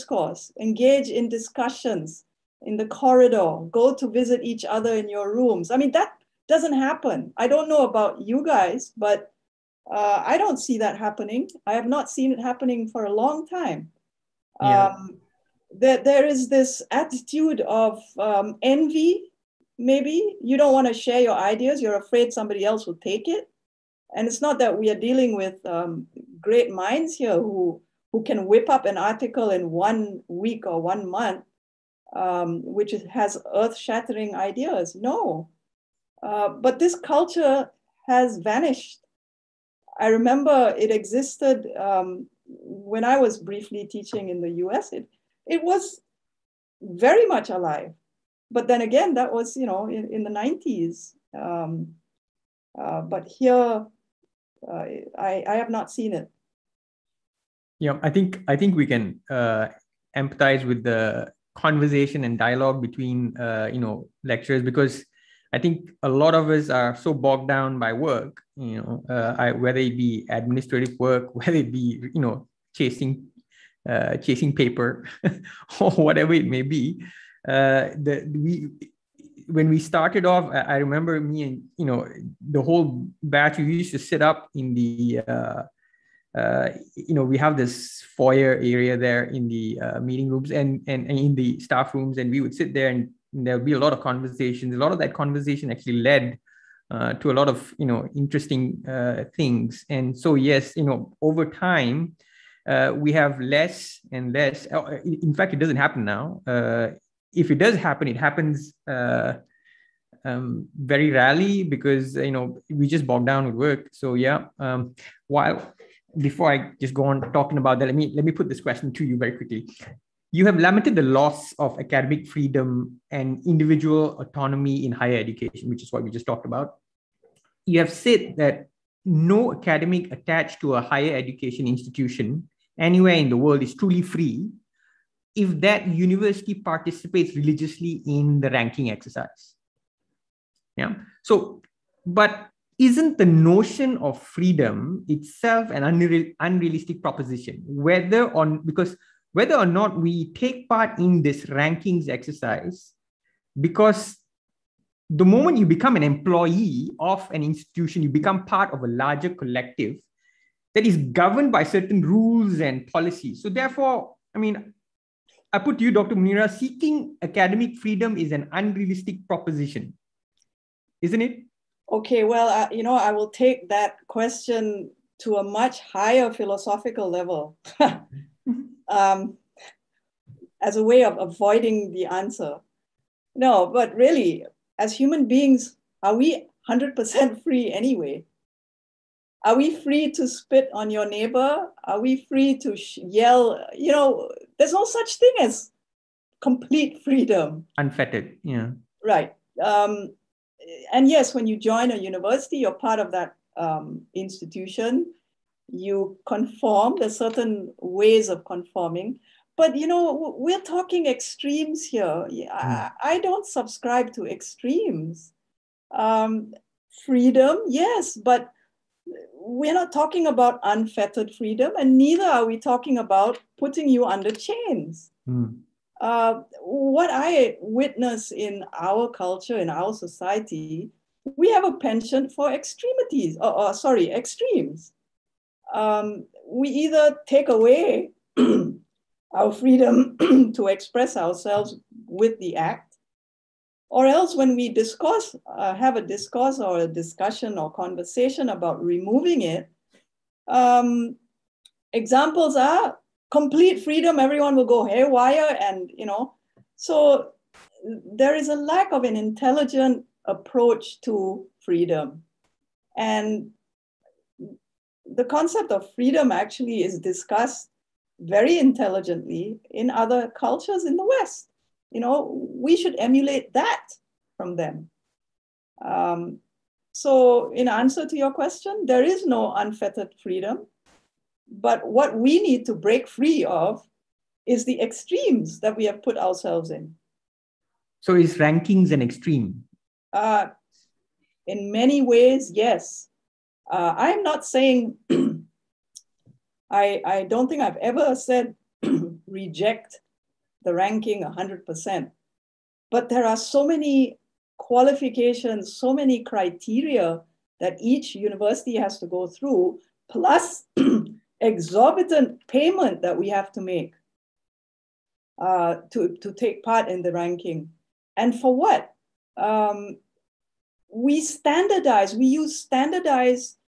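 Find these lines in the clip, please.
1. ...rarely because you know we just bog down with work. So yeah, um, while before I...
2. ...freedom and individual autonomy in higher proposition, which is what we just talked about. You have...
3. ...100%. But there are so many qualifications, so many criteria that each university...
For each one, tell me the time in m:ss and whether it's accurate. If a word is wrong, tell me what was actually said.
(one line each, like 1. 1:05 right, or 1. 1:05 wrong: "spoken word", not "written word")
1. 1:51 right
2. 2:02 wrong: "education", not "proposition"
3. 5:01 right.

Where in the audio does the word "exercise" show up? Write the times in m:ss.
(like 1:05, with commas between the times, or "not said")
2:18, 2:32.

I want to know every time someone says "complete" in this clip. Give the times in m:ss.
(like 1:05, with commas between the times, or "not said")
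3:16, 4:13.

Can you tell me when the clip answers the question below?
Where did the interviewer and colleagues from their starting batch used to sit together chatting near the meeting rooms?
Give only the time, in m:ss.
1:28.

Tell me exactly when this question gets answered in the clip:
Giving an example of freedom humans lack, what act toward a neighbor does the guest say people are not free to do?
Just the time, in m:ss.
3:10.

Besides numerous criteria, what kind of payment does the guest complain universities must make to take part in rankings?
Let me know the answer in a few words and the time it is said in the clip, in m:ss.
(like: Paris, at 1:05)
exorbitant payment, at 5:11.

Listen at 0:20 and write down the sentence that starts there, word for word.
You don't want to share your ideas, you're afraid somebody else will take it.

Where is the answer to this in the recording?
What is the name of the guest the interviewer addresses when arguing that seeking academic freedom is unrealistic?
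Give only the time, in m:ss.
2:45.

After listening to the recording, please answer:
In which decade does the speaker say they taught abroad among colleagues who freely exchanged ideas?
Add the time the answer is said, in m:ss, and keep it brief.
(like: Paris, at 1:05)
the 90s, at 0:50.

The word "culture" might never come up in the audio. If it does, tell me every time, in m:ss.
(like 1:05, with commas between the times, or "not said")
0:36, 3:49, 4:30.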